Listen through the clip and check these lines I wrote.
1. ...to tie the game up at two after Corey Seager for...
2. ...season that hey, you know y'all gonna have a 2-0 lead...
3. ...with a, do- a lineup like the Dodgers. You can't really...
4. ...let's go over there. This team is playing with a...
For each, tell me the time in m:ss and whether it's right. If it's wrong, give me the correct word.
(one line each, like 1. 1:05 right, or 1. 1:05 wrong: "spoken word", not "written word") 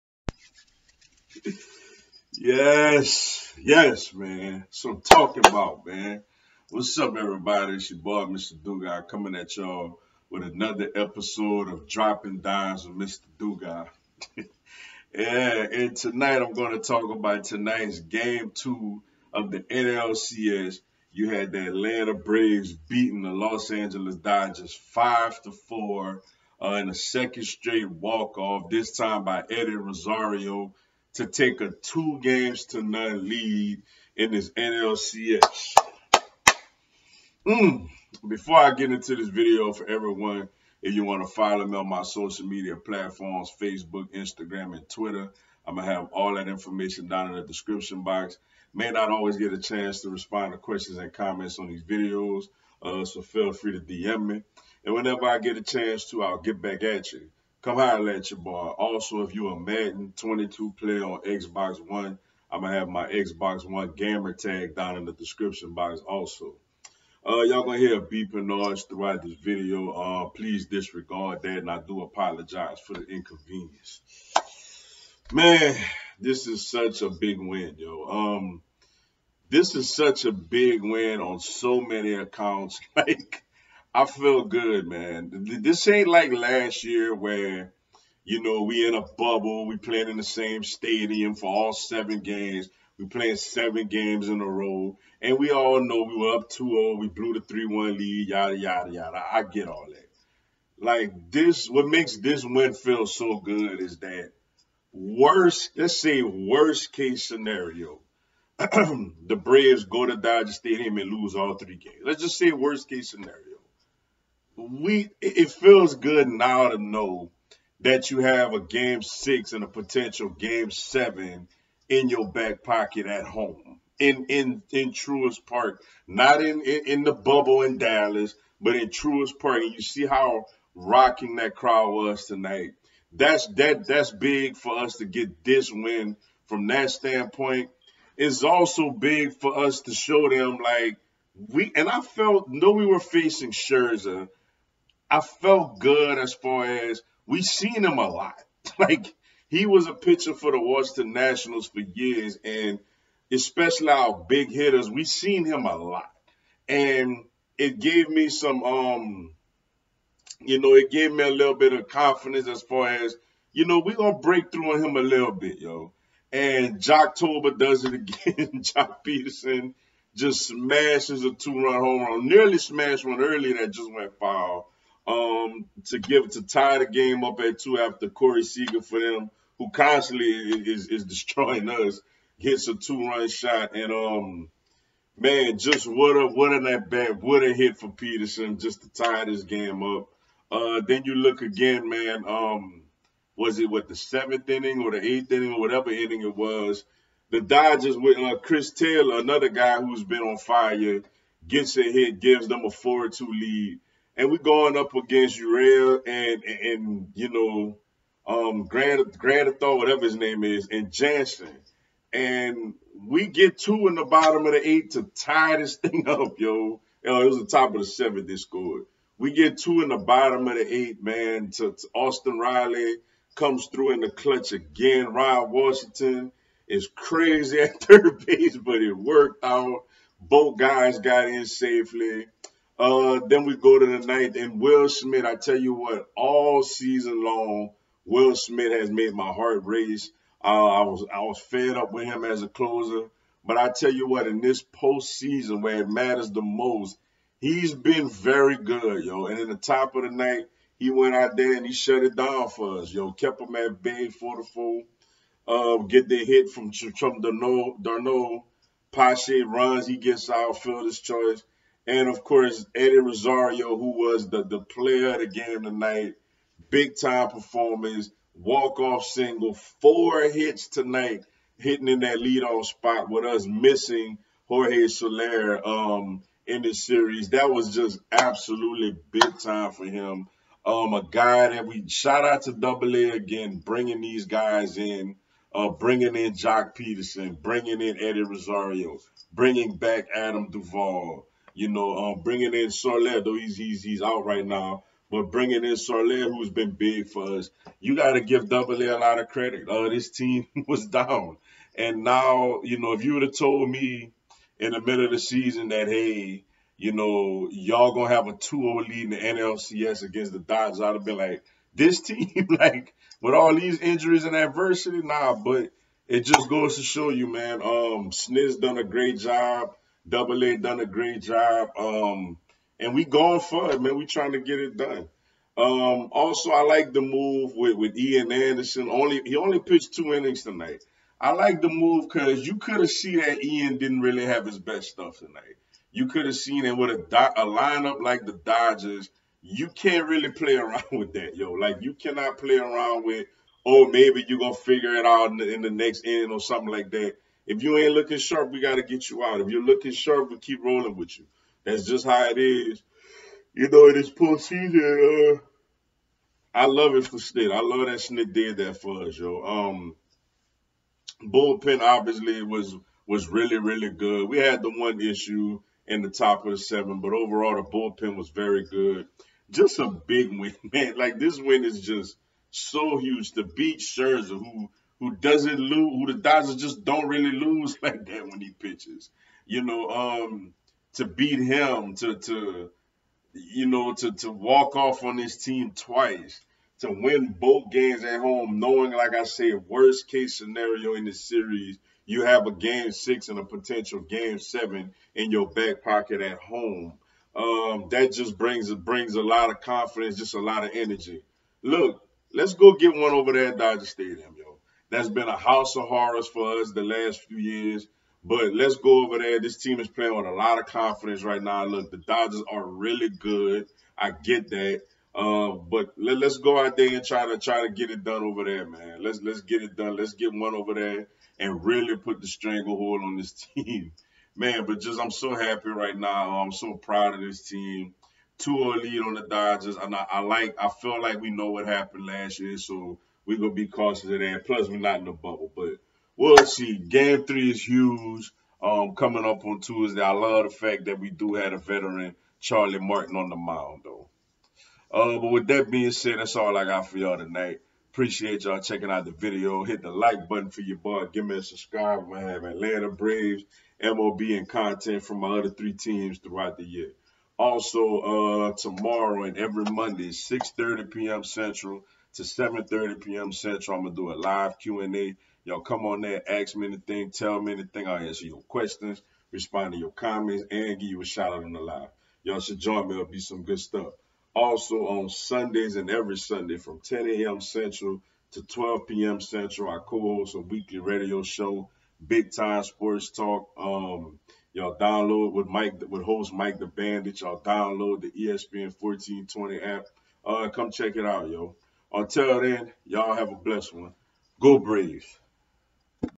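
1. 2:56 right
2. 5:05 right
3. 5:36 right
4. 6:48 right.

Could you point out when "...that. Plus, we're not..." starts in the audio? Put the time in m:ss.
7:14.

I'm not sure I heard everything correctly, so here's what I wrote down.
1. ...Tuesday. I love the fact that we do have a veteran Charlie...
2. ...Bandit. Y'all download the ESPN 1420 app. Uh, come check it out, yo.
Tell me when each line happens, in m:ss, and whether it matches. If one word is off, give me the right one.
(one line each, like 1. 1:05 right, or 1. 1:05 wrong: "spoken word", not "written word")
1. 7:19 right
2. 8:06 right.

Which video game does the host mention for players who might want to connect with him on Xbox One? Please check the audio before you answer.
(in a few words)
Madden 22.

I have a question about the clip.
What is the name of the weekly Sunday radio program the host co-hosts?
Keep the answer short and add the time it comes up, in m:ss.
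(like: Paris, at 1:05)
Big Time Sports Talk, at 8:02.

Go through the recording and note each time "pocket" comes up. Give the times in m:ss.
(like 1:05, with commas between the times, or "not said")
2:02, 6:35.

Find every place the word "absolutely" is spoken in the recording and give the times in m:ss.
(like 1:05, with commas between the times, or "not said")
4:38.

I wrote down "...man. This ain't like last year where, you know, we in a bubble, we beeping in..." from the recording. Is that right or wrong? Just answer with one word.
wrong.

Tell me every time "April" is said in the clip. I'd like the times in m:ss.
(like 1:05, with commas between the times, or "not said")
not said.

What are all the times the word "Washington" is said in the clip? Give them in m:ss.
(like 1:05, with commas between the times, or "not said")
2:30, 3:45.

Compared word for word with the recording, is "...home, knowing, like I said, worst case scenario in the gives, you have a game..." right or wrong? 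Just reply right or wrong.
wrong.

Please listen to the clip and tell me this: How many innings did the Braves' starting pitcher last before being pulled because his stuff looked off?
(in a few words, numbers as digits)
2.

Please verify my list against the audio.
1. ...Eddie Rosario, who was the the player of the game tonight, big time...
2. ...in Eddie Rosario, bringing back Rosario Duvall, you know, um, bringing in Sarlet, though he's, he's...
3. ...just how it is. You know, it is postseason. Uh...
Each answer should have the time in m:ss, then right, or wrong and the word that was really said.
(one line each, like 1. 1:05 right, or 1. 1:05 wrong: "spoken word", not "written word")
1. 4:22 right
2. 4:47 wrong: "Adam", not "Rosario"
3. 5:51 right.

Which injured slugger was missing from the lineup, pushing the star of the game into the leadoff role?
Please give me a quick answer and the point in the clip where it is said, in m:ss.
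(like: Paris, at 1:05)
Jorge Soler, at 4:34.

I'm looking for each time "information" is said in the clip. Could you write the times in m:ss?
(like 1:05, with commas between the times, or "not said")
0:46.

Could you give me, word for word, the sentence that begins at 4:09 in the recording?
And in the top of the night, he went out there and he shut it down for us, yo.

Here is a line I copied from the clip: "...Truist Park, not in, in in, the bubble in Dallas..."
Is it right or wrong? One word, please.
right.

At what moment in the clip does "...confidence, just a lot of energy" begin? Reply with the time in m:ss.
6:39.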